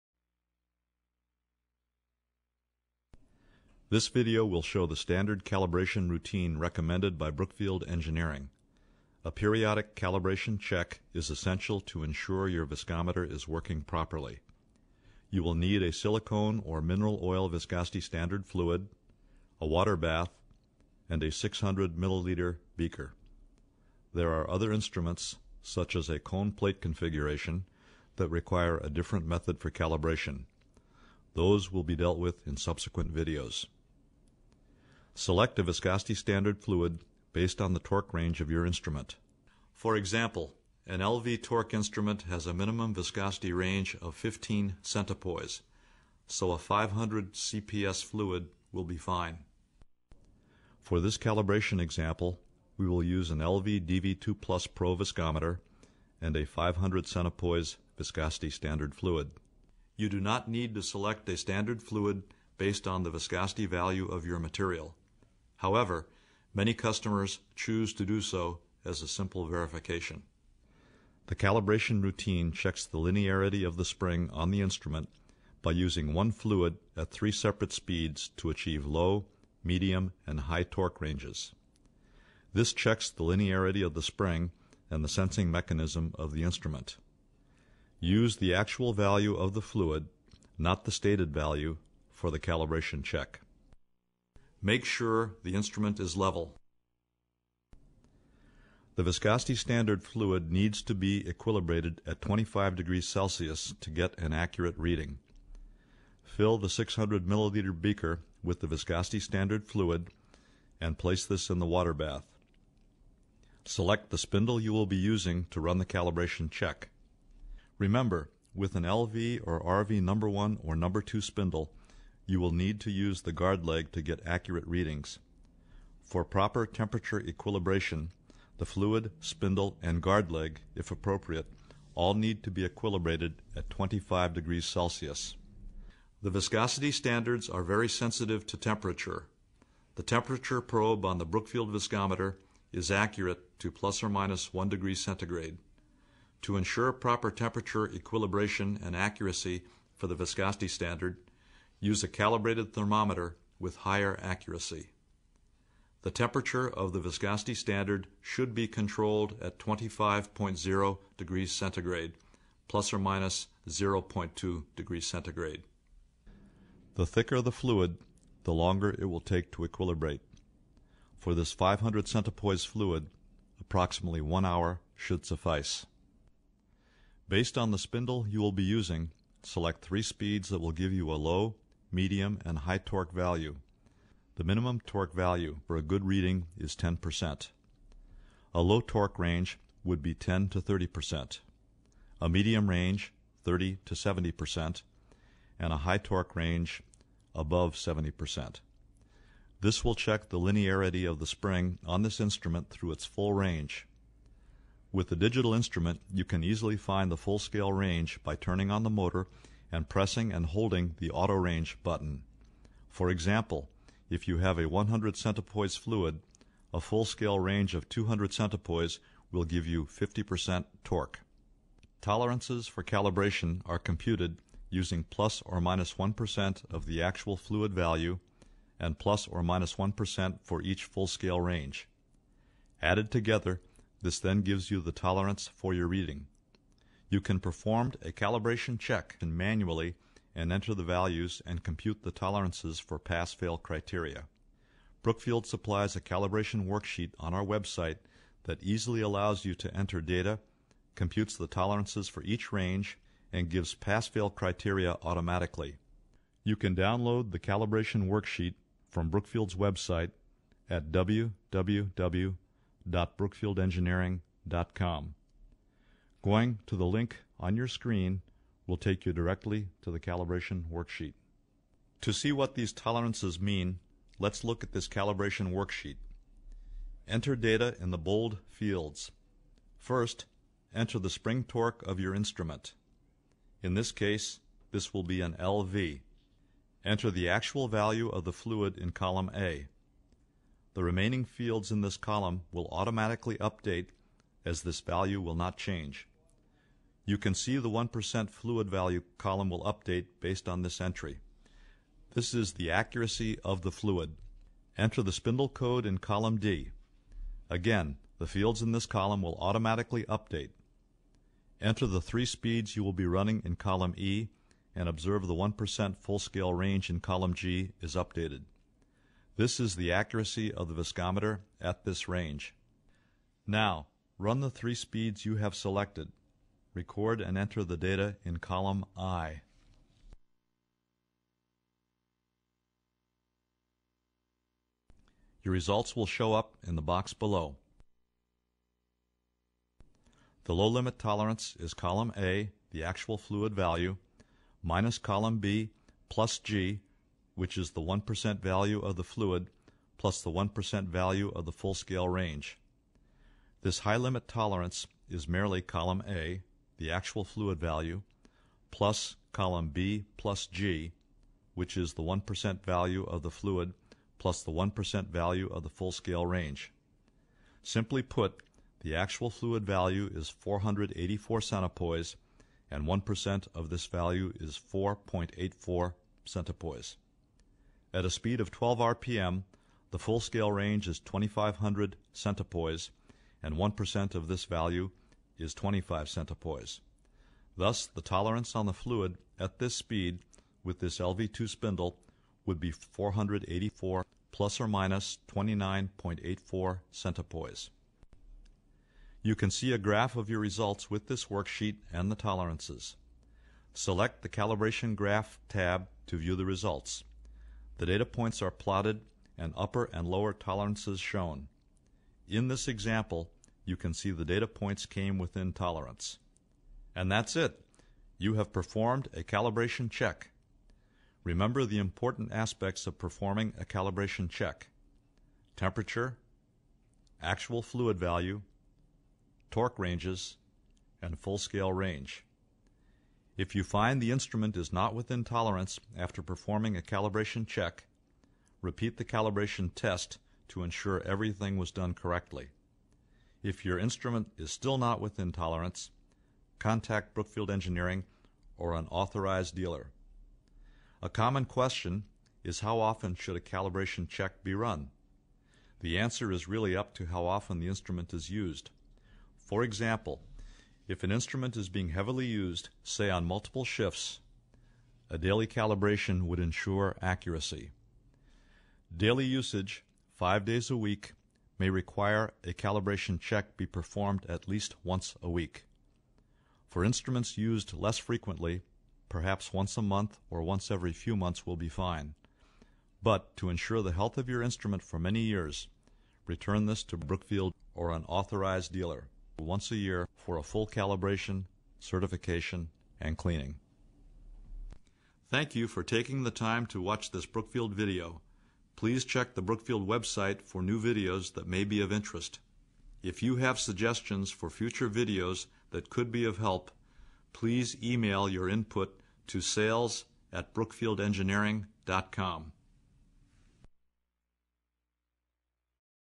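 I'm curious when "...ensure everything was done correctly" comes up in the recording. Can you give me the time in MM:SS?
07:20.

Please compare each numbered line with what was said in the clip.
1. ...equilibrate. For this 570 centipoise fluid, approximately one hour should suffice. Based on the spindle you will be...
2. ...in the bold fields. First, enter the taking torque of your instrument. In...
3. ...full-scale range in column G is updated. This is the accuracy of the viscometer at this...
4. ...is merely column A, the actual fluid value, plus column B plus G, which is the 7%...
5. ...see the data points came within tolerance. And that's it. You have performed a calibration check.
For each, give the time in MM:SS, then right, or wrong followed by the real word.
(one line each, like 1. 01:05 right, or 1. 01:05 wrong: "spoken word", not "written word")
1. 02:49 wrong: "500", not "570"
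2. 04:37 wrong: "spring", not "taking"
3. 05:15 right
4. 05:55 wrong: "1", not "7"
5. 06:53 right.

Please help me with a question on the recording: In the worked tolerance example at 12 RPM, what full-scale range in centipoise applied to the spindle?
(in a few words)
2500.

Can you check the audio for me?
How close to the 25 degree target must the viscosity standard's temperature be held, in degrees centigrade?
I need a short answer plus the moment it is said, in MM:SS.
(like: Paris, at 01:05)
plus or minus 0.2, at 02:42.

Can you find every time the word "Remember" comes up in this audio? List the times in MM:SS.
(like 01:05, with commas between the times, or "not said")
01:57, 07:01.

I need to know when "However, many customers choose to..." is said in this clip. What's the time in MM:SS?
01:05.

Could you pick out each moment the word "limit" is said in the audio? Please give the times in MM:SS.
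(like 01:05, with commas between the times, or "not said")
05:40, 05:53.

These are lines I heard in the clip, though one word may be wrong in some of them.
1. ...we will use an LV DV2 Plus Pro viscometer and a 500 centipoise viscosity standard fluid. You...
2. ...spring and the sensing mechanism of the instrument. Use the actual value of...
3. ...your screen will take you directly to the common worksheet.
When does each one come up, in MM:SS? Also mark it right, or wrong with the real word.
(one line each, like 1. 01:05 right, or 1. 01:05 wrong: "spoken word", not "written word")
1. 00:52 right
2. 01:24 right
3. 04:27 wrong: "calibration", not "common".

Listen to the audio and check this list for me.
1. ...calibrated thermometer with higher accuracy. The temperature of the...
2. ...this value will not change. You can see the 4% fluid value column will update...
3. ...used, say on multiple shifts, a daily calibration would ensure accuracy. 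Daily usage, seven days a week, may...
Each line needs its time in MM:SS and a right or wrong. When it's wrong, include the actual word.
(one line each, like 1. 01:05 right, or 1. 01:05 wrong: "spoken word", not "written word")
1. 02:32 right
2. 04:54 wrong: "1", not "4"
3. 07:42 wrong: "five", not "seven".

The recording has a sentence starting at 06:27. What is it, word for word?
Thus, the tolerance on the fluid at this speed with this LV2 spindle would be 484 plus or minus 29.84 centipoise.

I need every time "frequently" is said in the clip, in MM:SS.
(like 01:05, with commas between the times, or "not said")
07:57.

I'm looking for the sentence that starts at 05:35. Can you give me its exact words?
Your results will show up in the box below.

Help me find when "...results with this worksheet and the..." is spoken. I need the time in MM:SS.
06:40.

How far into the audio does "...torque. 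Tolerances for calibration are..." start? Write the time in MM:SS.
03:40.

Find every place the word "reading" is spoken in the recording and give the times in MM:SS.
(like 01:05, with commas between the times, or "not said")
01:44, 02:04, 03:06, 03:55.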